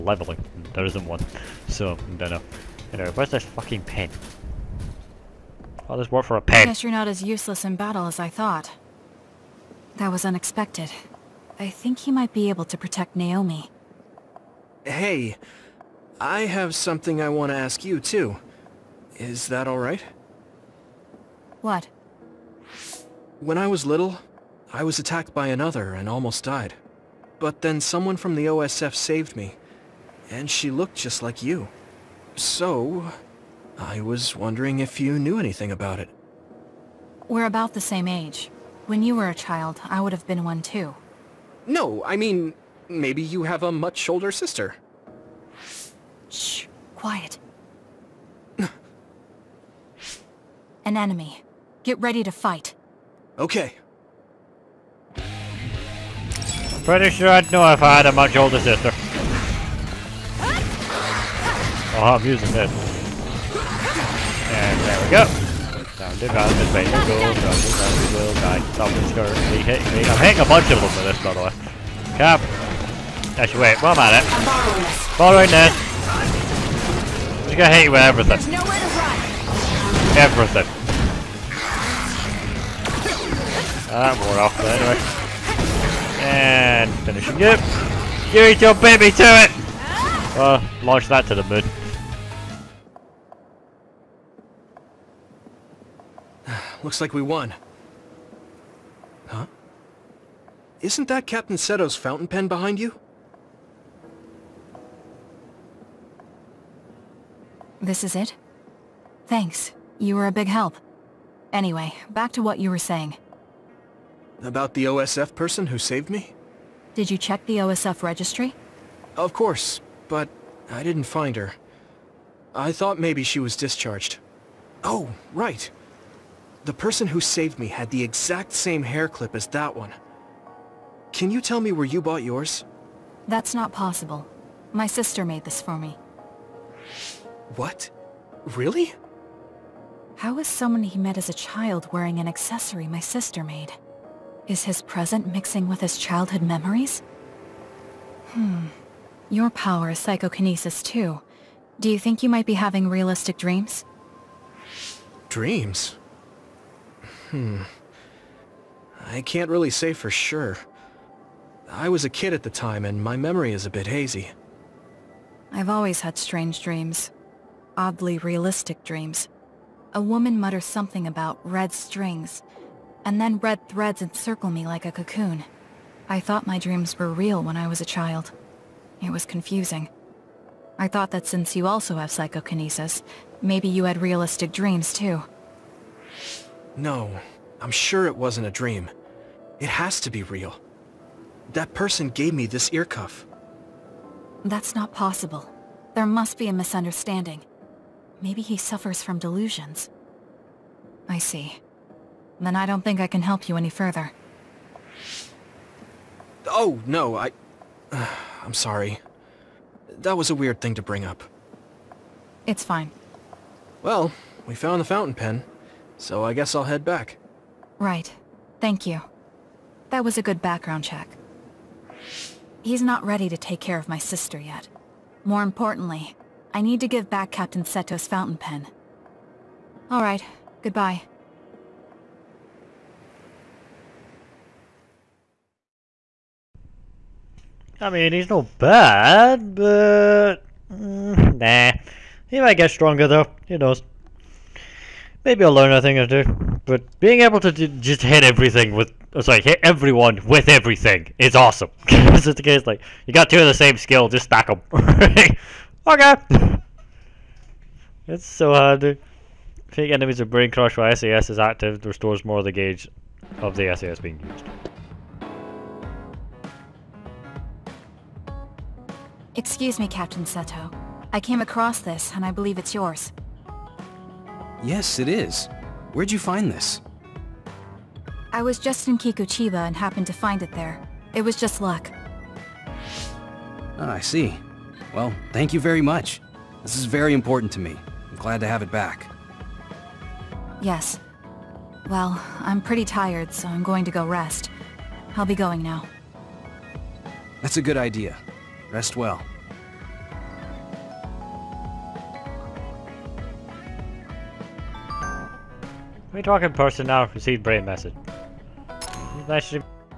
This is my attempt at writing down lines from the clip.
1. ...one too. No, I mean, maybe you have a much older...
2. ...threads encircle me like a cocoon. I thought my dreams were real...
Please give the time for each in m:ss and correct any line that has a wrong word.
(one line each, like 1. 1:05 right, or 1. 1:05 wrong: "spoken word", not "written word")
1. 0:40 right
2. 2:53 right.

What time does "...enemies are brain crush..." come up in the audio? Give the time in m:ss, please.
4:19.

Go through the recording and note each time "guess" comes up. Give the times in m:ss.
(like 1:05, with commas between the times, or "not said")
0:06, 3:36.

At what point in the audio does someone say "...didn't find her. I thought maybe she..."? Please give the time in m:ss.
2:00.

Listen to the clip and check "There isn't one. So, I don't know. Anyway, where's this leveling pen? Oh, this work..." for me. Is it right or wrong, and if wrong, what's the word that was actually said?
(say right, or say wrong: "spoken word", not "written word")
wrong: "fucking", not "leveling".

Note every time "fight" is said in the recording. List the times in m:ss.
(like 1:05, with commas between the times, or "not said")
0:52.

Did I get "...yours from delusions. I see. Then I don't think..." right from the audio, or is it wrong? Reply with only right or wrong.
wrong.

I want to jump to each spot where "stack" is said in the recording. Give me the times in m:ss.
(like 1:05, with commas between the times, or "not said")
4:14.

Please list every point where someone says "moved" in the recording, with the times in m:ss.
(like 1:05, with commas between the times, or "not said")
not said.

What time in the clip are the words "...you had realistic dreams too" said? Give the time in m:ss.
3:03.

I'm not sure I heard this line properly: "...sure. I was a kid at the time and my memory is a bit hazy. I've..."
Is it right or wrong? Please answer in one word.
right.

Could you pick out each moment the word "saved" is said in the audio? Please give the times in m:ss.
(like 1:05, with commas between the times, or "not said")
0:28, 1:55, 2:07.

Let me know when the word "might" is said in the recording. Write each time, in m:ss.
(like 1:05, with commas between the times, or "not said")
0:12, 2:32, 4:02.